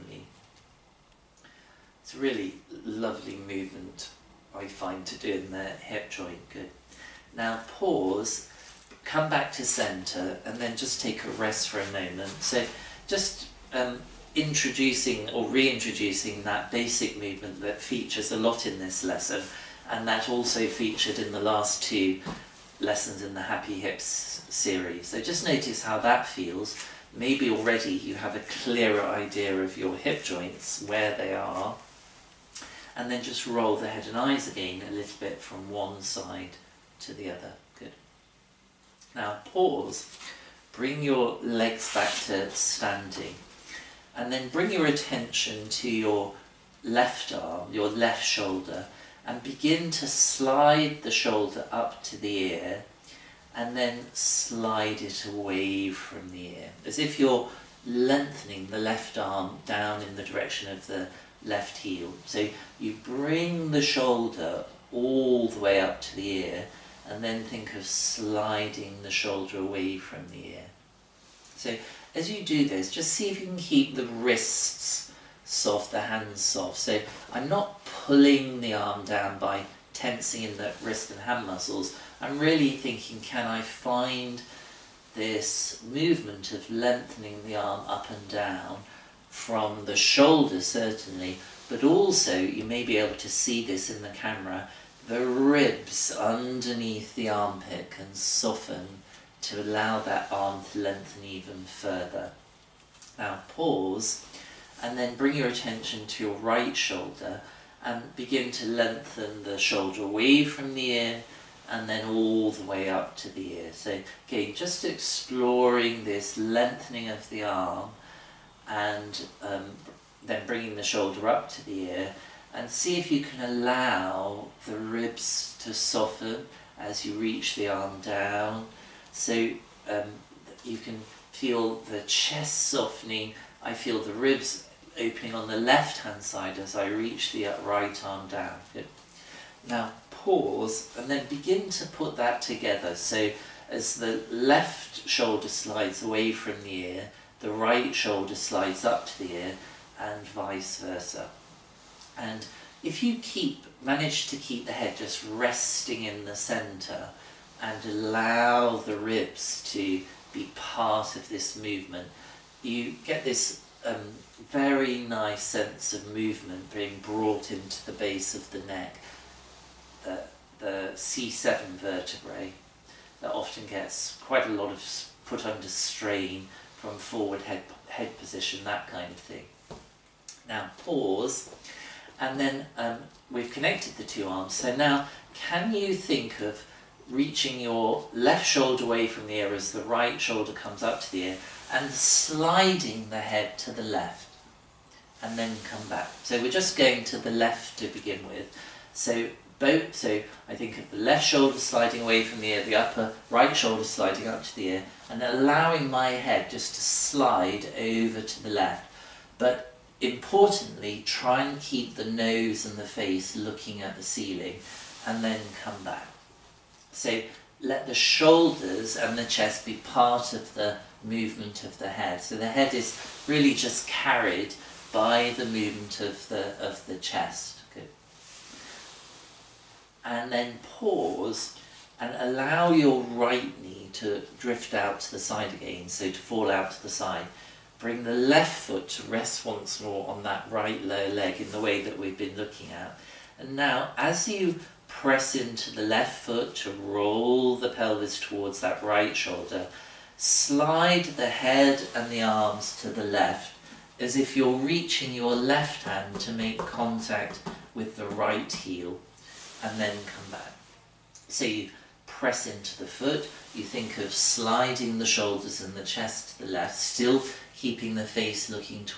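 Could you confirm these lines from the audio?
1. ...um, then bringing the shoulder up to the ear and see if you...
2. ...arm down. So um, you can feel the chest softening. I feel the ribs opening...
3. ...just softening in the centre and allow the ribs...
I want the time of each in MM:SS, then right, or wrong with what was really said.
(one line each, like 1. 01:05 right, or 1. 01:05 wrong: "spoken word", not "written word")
1. 01:59 right
2. 02:07 right
3. 02:34 wrong: "resting", not "softening".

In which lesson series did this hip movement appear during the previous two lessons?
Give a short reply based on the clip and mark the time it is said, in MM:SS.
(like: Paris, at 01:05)
Happy Hips, at 00:23.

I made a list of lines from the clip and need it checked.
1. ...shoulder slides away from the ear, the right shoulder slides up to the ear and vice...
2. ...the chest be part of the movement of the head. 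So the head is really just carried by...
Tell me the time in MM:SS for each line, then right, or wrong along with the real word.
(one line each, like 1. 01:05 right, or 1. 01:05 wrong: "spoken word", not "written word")
1. 02:25 right
2. 03:39 right.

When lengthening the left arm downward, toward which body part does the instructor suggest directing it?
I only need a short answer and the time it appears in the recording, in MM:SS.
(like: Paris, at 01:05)
left heel, at 01:01.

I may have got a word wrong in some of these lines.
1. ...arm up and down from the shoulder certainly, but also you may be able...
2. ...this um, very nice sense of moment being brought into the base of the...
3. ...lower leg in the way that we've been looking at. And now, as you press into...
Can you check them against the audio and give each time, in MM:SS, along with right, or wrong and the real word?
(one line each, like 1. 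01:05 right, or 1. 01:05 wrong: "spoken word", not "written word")
1. 01:27 right
2. 02:43 wrong: "movement", not "moment"
3. 04:00 right.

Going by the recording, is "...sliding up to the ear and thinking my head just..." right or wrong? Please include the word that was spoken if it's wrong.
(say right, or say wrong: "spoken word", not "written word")
wrong: "allowing", not "thinking".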